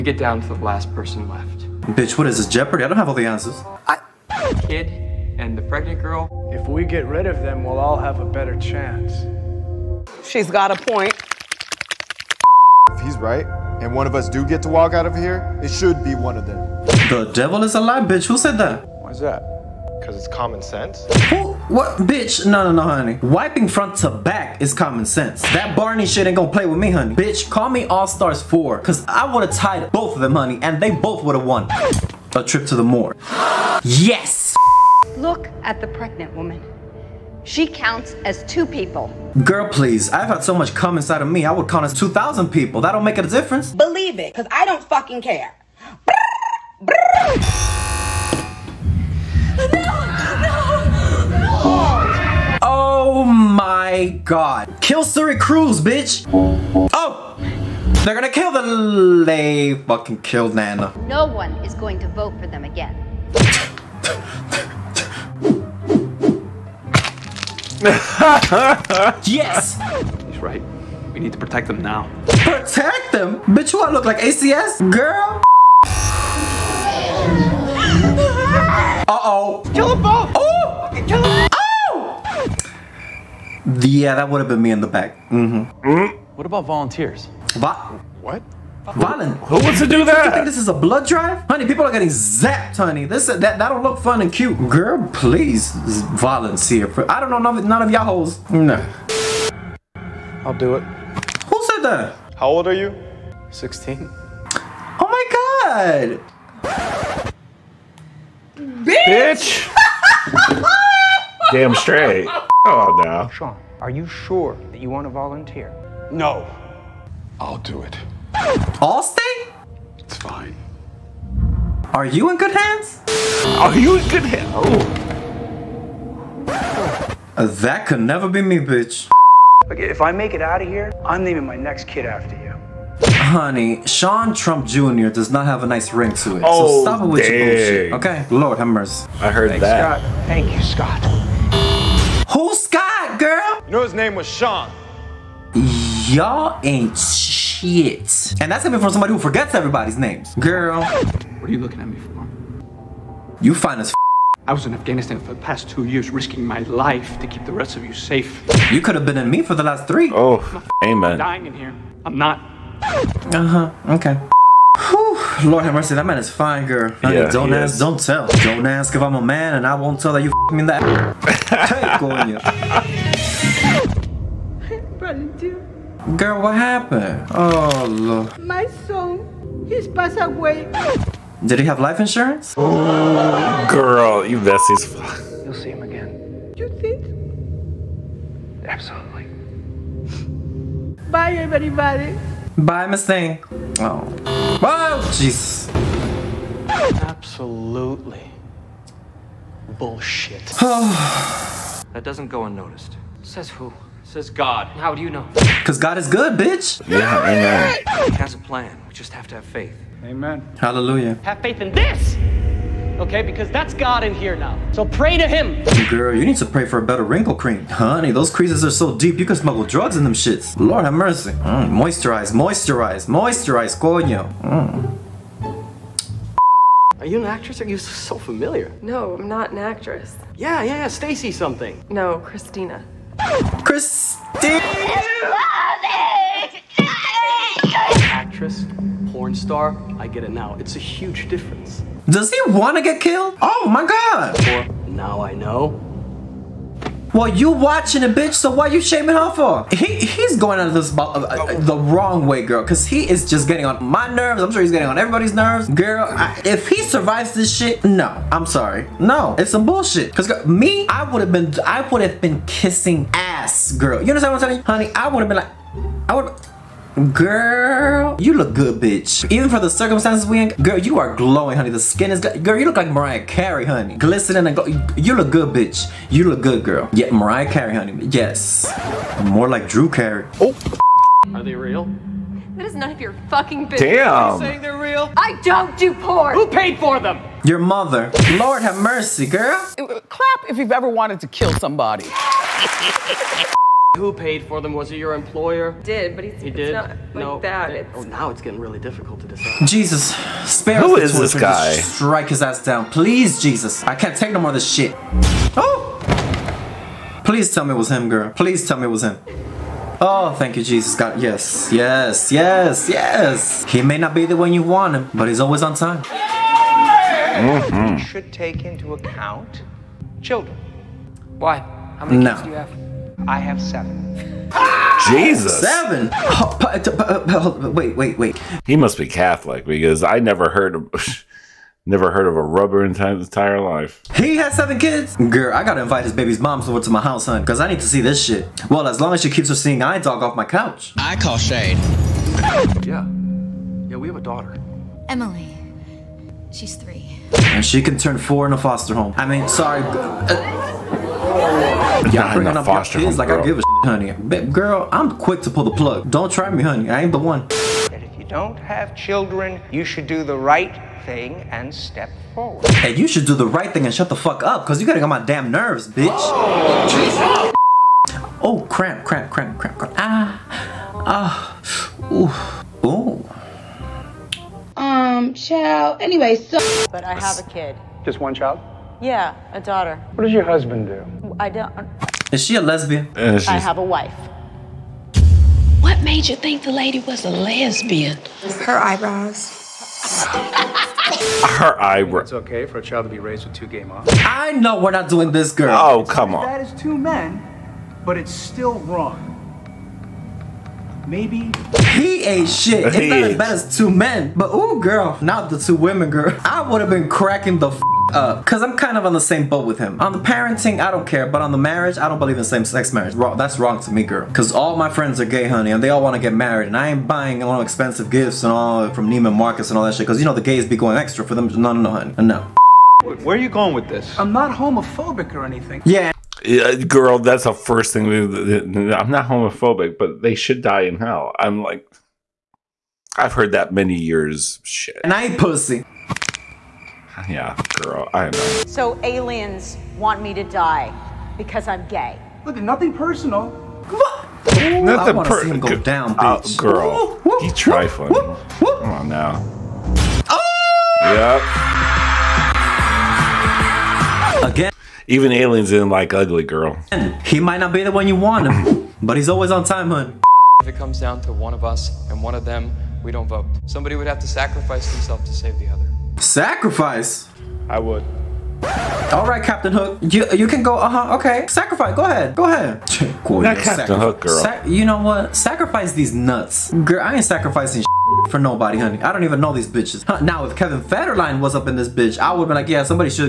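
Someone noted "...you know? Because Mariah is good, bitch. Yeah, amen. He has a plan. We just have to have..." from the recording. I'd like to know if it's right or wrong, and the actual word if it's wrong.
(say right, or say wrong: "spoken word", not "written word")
wrong: "God", not "Mariah".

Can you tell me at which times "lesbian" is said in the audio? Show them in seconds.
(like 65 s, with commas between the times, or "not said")
382 s, 387 s.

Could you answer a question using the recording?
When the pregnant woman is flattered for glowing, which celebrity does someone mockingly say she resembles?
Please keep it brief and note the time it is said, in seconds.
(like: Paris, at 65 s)
Drew Carey, at 279 s.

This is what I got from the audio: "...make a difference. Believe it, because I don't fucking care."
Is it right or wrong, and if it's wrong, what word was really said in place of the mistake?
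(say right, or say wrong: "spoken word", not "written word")
right.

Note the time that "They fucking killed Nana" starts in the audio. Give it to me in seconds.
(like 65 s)
59 s.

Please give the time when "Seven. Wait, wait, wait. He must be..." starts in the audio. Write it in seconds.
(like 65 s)
325 s.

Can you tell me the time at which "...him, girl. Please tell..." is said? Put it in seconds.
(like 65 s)
307 s.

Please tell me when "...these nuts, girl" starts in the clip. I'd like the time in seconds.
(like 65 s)
475 s.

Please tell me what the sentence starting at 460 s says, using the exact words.
If it comes down to one of us and one of them, we don't vote.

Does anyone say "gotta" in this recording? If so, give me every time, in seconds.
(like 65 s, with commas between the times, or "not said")
335 s, 364 s.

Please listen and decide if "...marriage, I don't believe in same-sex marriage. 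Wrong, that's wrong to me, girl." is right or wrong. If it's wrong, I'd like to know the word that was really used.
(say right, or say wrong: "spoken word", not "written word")
right.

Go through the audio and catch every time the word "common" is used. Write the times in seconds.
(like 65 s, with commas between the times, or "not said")
20 s, 24 s.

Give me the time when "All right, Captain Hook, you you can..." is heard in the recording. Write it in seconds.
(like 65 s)
469 s.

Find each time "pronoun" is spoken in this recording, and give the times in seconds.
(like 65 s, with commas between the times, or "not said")
not said.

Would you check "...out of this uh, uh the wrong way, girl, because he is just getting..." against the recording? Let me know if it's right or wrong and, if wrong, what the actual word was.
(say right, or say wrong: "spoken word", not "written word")
right.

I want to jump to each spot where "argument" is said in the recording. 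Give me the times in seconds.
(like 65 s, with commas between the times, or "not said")
not said.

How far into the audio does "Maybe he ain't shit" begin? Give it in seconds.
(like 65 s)
401 s.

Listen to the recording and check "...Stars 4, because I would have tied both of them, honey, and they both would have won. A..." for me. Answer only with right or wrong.
right.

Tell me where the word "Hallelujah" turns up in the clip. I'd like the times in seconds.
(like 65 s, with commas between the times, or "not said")
210 s.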